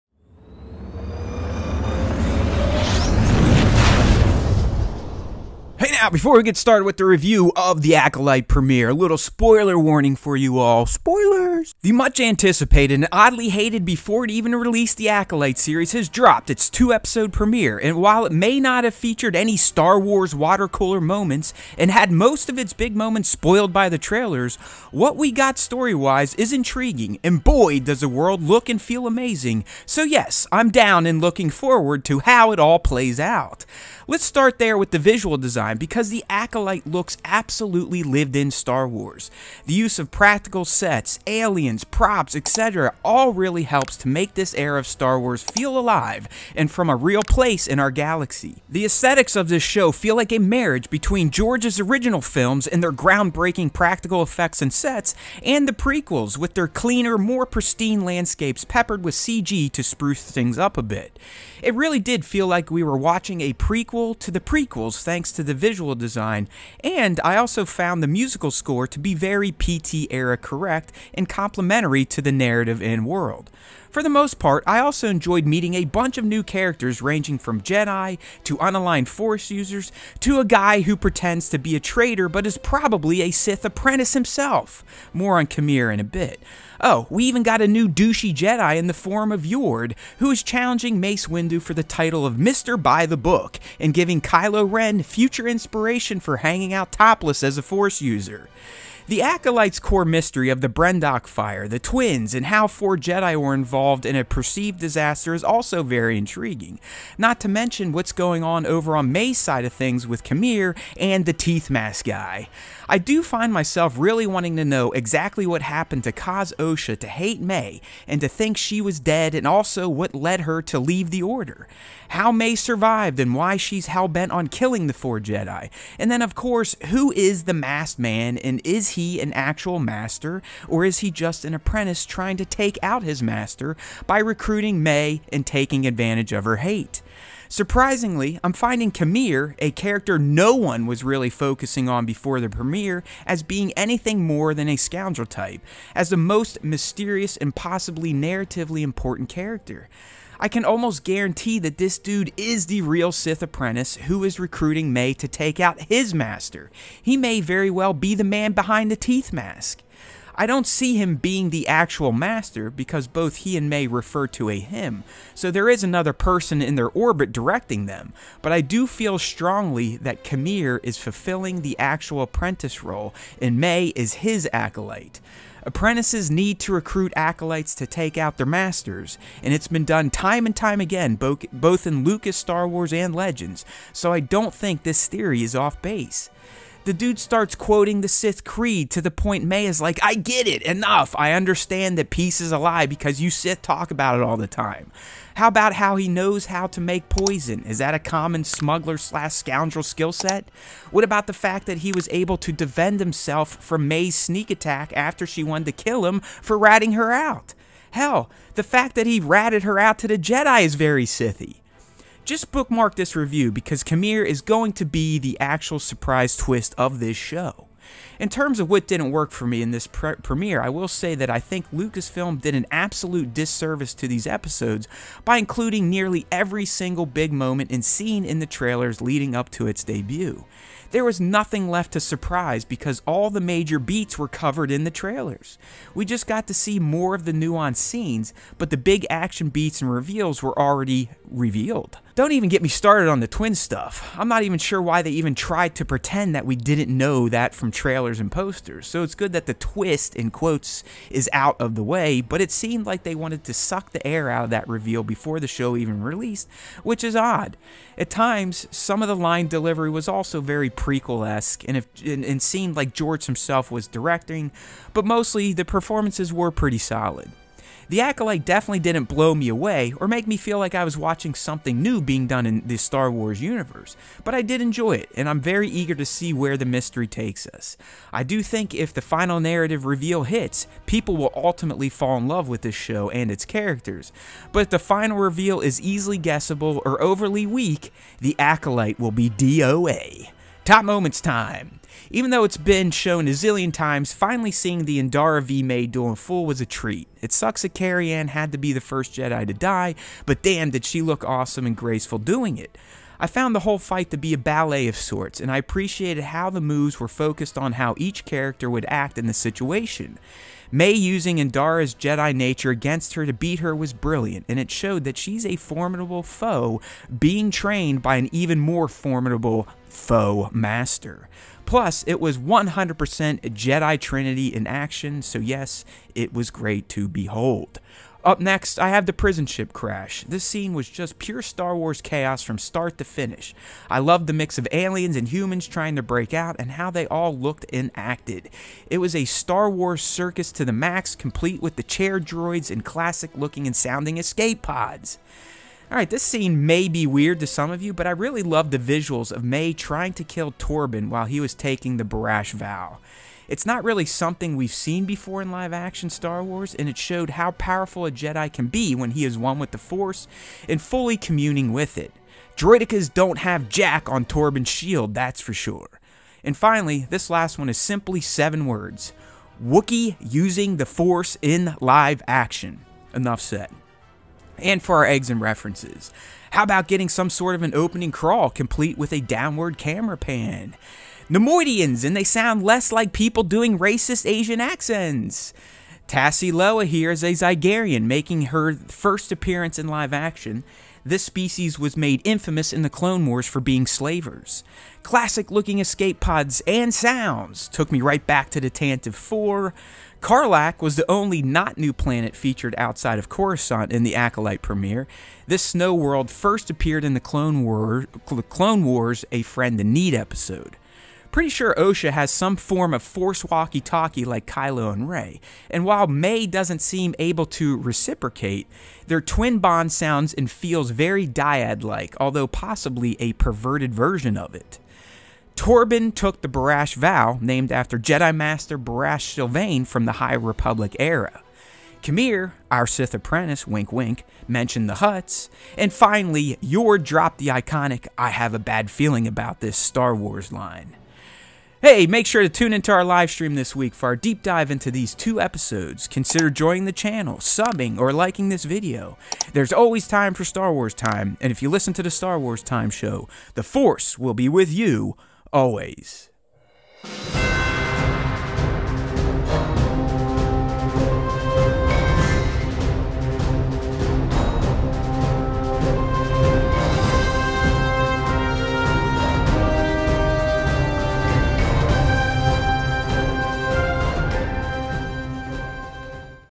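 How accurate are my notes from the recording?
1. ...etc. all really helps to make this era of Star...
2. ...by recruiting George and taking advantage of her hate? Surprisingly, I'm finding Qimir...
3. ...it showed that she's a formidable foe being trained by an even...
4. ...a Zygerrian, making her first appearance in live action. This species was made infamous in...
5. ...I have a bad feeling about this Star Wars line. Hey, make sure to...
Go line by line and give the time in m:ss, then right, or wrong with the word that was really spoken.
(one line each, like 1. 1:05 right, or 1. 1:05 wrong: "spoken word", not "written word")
1. 0:42 right
2. 2:14 wrong: "Mae", not "George"
3. 5:14 right
4. 6:27 right
5. 7:18 right.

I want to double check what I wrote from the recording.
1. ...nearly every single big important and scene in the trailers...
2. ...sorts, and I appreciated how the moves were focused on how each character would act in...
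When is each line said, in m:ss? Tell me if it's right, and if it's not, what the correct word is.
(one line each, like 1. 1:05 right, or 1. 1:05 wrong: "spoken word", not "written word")
1. 3:45 wrong: "moment", not "important"
2. 5:04 right.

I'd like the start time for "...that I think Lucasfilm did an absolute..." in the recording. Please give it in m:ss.
3:41.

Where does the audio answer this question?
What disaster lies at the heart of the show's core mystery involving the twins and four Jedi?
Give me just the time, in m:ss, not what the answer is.
1:40.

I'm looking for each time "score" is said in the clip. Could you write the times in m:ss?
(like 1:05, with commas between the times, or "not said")
1:08.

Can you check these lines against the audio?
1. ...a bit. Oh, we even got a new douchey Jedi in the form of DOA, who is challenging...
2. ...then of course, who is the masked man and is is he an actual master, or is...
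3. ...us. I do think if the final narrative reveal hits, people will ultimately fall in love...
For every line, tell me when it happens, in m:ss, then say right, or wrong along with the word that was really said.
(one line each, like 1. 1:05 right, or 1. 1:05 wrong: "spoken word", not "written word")
1. 1:25 wrong: "Yord", not "DOA"
2. 2:06 right
3. 4:37 right.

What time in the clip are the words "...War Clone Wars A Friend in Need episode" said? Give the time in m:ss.
6:47.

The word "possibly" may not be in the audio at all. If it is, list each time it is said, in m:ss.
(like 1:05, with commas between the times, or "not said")
2:27, 7:02.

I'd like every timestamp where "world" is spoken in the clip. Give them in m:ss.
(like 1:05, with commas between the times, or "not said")
0:28, 1:13, 6:45.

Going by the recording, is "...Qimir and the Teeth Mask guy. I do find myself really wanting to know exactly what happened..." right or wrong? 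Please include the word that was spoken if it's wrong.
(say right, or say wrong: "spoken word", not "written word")
right.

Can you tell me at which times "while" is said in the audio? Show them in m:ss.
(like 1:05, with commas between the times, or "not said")
0:18, 5:51, 6:55.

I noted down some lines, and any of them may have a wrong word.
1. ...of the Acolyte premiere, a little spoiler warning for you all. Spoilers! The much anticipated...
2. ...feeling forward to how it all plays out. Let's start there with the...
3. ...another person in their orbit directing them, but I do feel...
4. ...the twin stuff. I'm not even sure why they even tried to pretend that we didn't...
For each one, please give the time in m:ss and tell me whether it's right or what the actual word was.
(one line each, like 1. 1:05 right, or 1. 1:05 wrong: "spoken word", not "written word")
1. 0:07 right
2. 0:31 wrong: "looking", not "feeling"
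3. 2:45 right
4. 4:03 right.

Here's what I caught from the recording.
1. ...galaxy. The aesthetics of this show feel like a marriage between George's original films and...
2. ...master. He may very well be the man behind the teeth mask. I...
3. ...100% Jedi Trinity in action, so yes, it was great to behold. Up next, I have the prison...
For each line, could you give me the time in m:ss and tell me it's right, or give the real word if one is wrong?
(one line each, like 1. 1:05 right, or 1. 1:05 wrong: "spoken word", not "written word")
1. 0:47 right
2. 2:36 right
3. 5:22 right.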